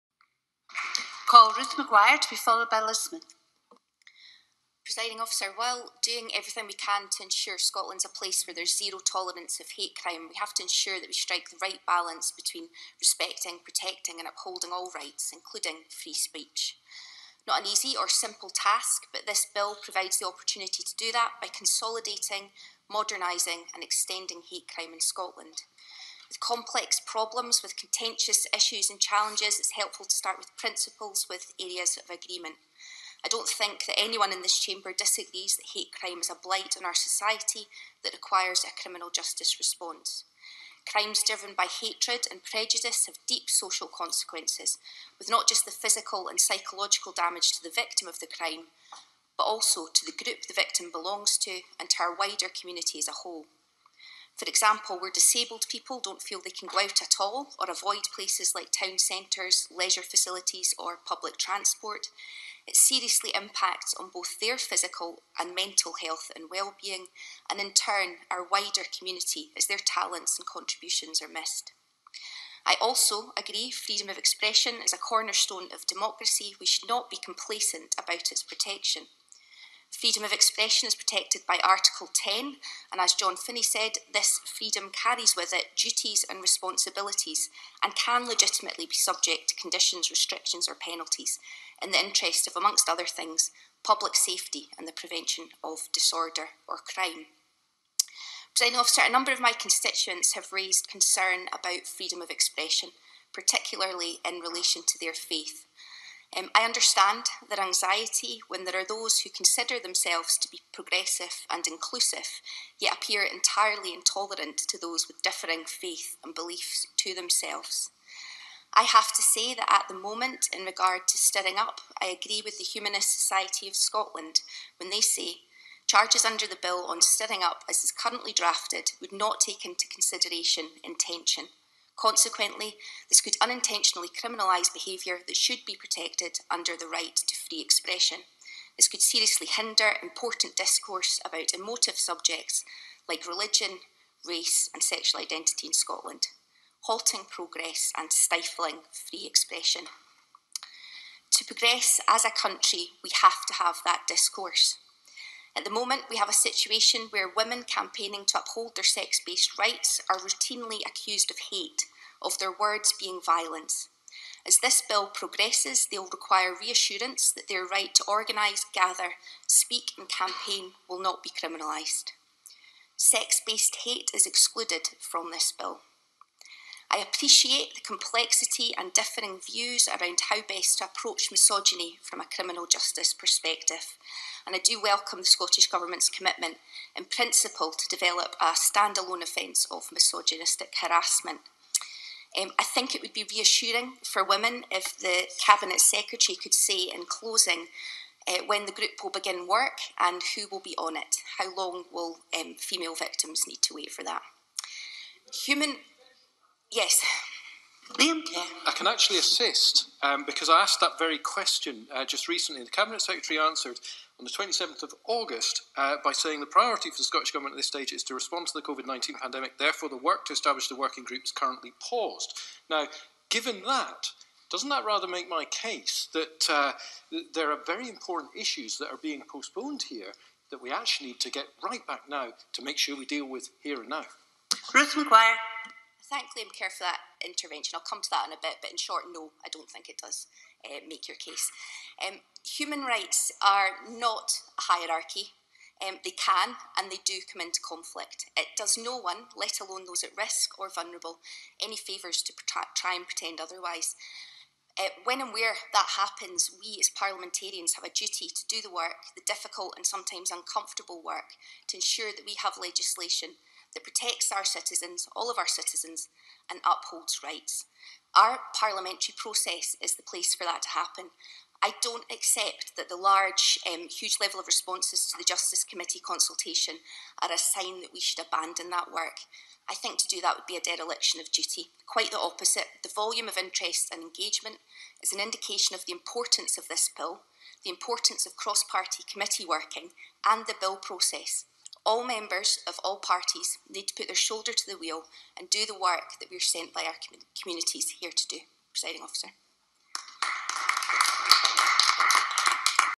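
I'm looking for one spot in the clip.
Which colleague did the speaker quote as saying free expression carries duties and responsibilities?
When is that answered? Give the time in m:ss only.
1:23.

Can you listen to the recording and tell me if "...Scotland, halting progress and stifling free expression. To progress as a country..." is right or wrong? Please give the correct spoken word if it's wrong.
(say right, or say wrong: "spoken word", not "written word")
right.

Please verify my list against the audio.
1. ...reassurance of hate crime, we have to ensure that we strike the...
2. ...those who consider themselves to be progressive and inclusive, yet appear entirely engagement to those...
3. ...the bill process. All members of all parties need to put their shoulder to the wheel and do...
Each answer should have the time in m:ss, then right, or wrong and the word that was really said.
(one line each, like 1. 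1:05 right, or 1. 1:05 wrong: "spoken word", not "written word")
1. 0:08 wrong: "tolerance", not "reassurance"
2. 1:48 wrong: "intolerant", not "engagement"
3. 4:50 right.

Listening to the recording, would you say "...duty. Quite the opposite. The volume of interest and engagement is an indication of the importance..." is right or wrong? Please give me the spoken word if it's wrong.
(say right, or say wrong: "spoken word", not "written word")
right.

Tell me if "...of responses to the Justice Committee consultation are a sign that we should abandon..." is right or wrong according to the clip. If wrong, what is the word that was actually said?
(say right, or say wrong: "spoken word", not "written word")
right.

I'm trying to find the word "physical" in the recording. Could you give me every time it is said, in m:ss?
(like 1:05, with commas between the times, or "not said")
0:45, 1:04.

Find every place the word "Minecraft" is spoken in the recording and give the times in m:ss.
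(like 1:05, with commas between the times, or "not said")
not said.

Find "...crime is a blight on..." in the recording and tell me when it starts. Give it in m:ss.
0:35.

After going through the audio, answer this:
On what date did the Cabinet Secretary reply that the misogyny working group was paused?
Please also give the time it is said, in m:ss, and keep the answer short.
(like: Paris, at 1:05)
27th of August, at 3:34.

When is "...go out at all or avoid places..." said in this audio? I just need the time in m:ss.
0:56.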